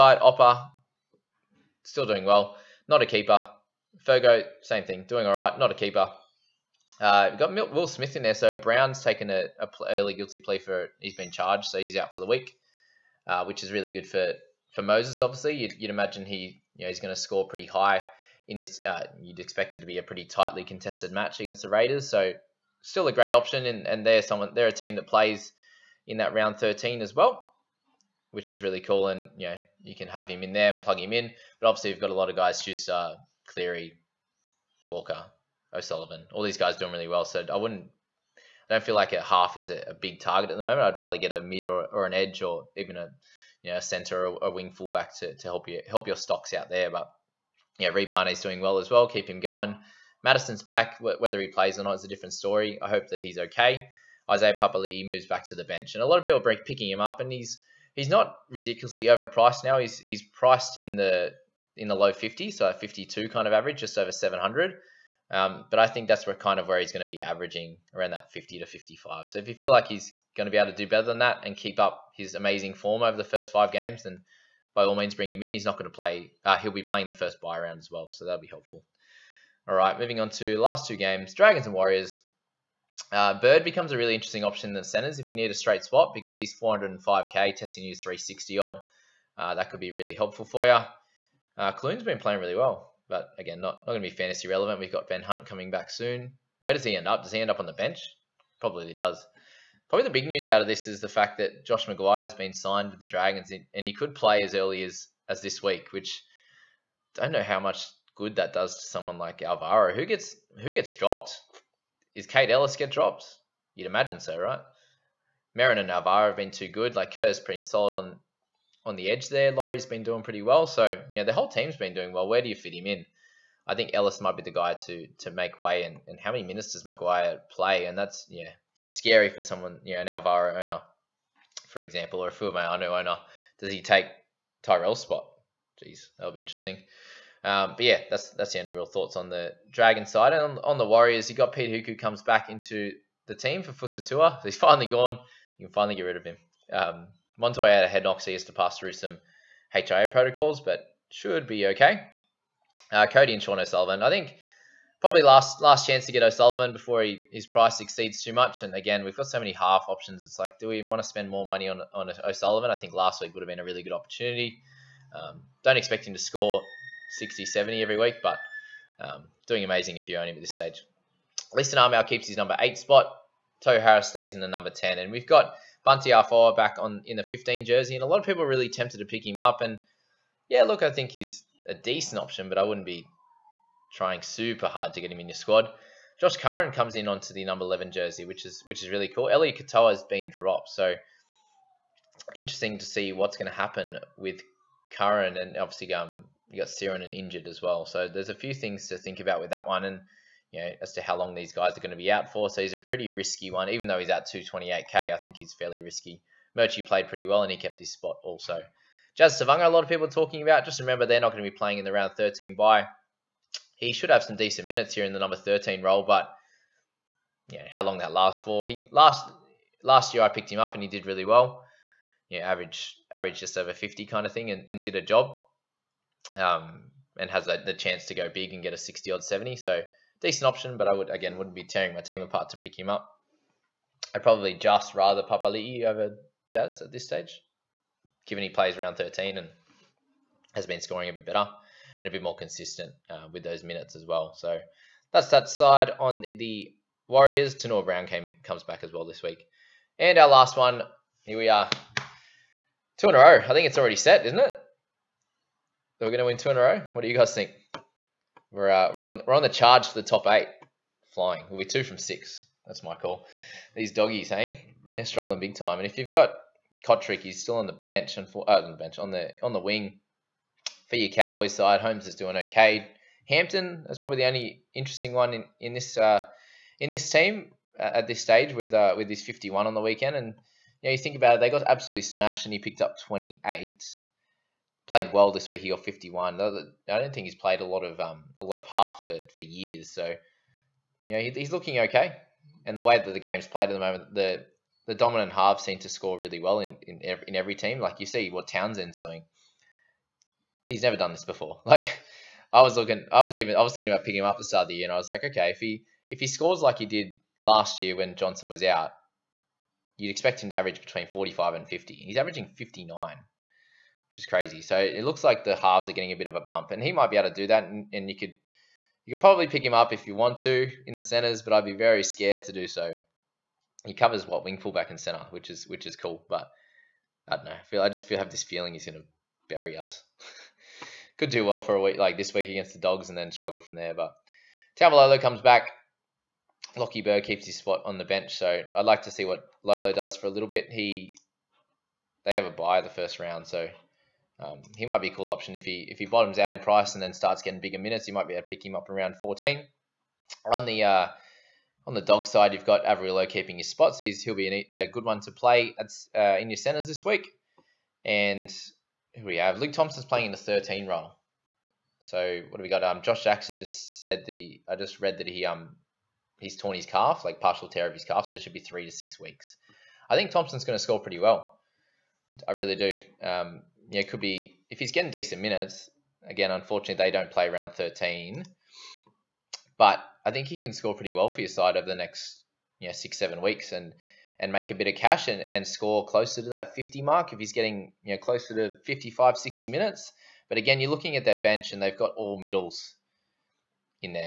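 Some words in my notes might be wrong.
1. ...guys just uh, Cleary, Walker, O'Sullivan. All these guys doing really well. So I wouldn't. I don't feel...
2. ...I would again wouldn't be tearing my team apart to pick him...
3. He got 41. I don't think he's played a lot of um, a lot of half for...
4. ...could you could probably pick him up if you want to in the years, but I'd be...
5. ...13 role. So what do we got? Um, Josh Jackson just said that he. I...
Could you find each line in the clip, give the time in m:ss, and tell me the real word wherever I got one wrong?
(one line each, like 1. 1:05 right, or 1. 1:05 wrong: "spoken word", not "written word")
1. 0:32 right
2. 3:50 right
3. 4:45 wrong: "51", not "41"
4. 5:18 wrong: "centers", not "years"
5. 6:00 right.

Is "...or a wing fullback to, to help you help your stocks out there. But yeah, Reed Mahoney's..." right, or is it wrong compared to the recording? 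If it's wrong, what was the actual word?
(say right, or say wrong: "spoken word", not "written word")
right.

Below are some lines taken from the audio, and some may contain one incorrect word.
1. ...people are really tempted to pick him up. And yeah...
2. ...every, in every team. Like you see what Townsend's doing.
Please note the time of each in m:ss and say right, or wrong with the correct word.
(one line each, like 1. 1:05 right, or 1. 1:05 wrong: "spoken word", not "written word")
1. 2:58 right
2. 4:57 right.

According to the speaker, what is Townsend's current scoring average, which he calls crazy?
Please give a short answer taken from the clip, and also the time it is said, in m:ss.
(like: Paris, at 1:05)
59, at 5:12.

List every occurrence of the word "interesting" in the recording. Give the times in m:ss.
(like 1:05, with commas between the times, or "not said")
1:24, 2:16, 3:12, 4:34.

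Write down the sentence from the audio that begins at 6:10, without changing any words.
I think Thompson's going to score pretty well.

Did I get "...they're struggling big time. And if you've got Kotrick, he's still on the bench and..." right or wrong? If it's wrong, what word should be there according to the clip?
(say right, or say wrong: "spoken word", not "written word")
right.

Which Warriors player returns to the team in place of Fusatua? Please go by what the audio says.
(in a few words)
Peta Hiku.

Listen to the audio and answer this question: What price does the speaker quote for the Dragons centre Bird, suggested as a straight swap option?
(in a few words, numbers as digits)
405k.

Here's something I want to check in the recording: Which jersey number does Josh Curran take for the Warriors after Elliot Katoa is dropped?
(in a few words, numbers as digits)
11.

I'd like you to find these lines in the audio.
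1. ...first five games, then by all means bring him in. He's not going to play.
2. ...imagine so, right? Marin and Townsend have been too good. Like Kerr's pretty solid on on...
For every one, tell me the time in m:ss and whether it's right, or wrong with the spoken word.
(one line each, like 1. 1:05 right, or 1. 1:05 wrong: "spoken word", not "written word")
1. 1:13 right
2. 1:53 wrong: "Alvaro", not "Townsend".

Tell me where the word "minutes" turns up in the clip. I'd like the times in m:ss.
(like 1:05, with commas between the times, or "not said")
2:06, 3:34, 4:03, 5:47, 6:15, 6:29.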